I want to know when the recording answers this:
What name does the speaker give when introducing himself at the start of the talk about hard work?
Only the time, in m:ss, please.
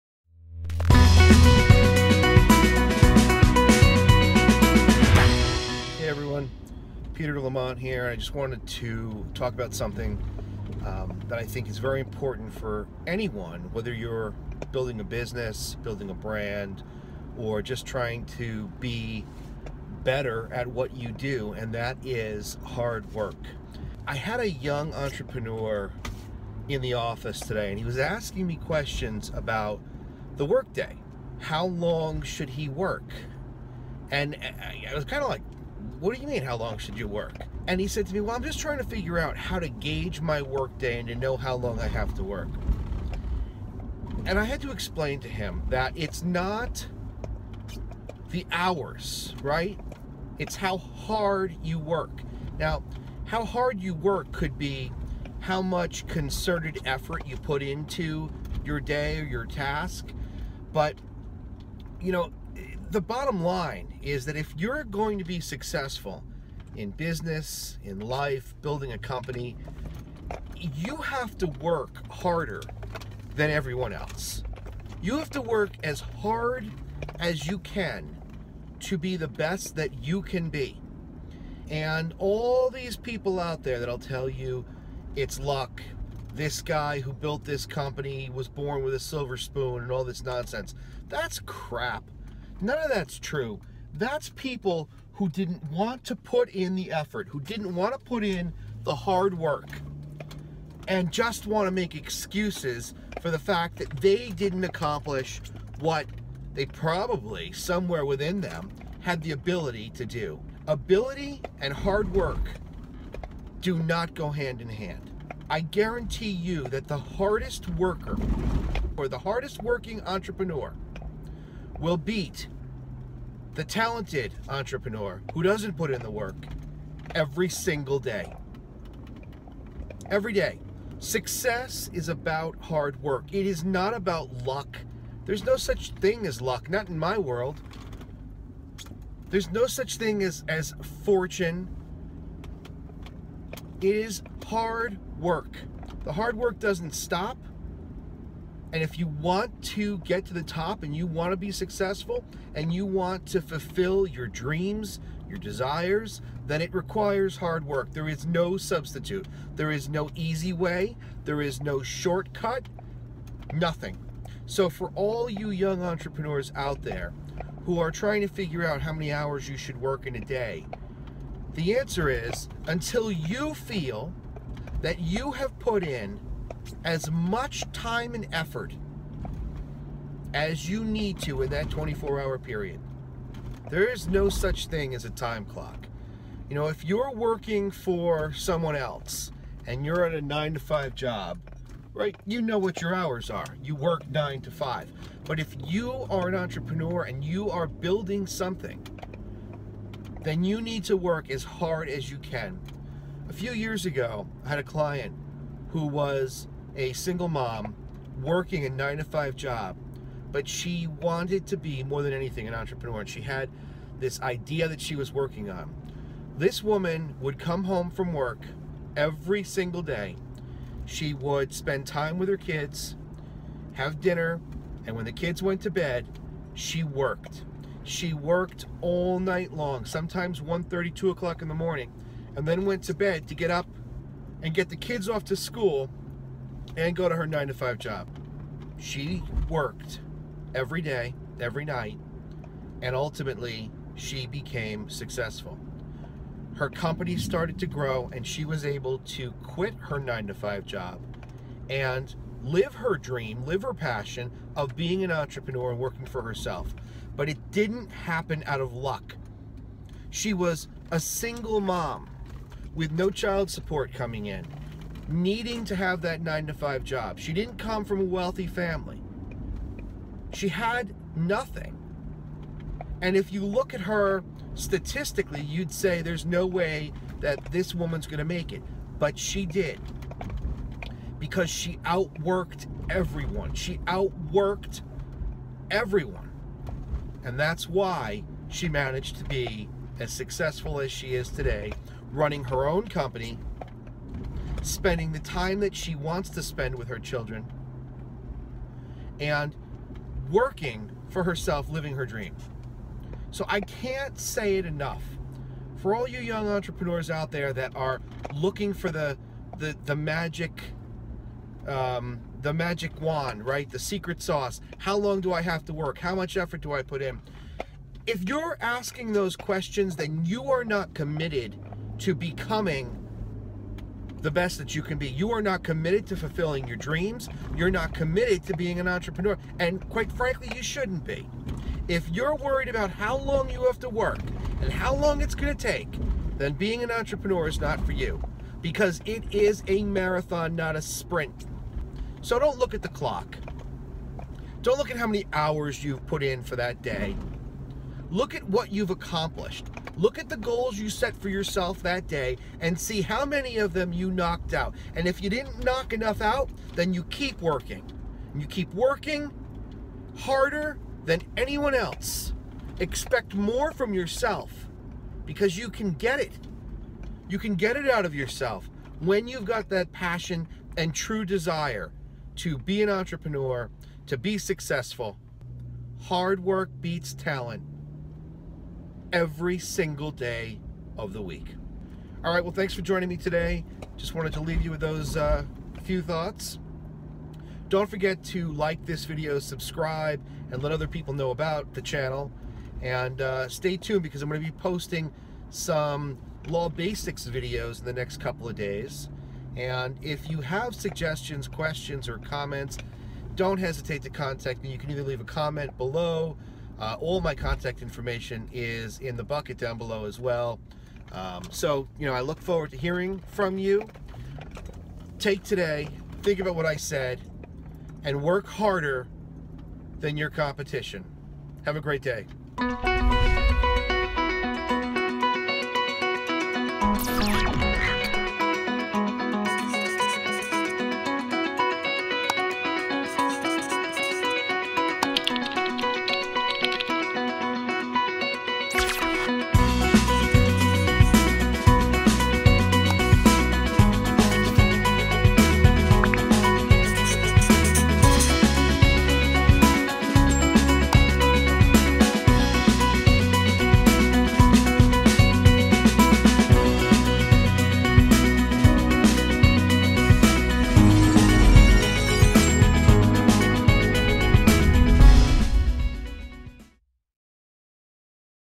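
0:07.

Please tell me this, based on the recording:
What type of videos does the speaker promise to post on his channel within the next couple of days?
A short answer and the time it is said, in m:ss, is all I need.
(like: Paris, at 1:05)
law basics, at 6:36.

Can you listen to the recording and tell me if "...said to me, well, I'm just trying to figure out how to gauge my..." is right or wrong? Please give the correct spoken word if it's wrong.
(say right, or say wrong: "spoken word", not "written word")
right.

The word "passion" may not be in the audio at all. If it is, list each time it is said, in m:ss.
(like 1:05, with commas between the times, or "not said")
4:13, 6:09.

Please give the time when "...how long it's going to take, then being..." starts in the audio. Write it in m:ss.
5:34.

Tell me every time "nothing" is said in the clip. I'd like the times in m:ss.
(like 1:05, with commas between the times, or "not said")
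2:43, 4:31.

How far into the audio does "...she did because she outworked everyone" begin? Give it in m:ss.
4:39.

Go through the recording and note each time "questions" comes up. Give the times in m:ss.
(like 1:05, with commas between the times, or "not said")
0:28, 5:19, 6:41.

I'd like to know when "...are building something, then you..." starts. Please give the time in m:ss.
3:17.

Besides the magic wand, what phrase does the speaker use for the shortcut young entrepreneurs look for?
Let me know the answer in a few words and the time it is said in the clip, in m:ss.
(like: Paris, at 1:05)
secret sauce, at 5:13.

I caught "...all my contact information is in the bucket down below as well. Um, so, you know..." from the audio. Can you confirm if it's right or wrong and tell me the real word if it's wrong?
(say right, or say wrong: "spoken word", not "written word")
right.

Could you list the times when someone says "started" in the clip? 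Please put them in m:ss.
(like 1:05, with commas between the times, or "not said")
4:07.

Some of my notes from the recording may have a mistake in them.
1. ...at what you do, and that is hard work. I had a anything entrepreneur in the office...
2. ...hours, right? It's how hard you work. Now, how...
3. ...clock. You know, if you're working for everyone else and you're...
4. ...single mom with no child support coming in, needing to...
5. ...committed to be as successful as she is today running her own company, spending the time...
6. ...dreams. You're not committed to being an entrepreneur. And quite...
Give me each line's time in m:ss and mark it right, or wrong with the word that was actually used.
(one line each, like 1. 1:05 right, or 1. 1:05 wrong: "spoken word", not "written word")
1. 0:20 wrong: "young", not "anything"
2. 0:48 right
3. 3:05 wrong: "someone", not "everyone"
4. 4:20 right
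5. 4:48 wrong: "managed", not "committed"
6. 5:26 right.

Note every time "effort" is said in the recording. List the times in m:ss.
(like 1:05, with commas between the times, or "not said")
0:56, 1:36, 2:58, 5:16.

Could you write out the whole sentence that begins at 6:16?
Hard work beats talent every single day of the week.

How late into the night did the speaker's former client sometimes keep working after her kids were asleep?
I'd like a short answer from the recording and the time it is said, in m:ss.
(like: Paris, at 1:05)
2 o'clock in the morning, at 3:50.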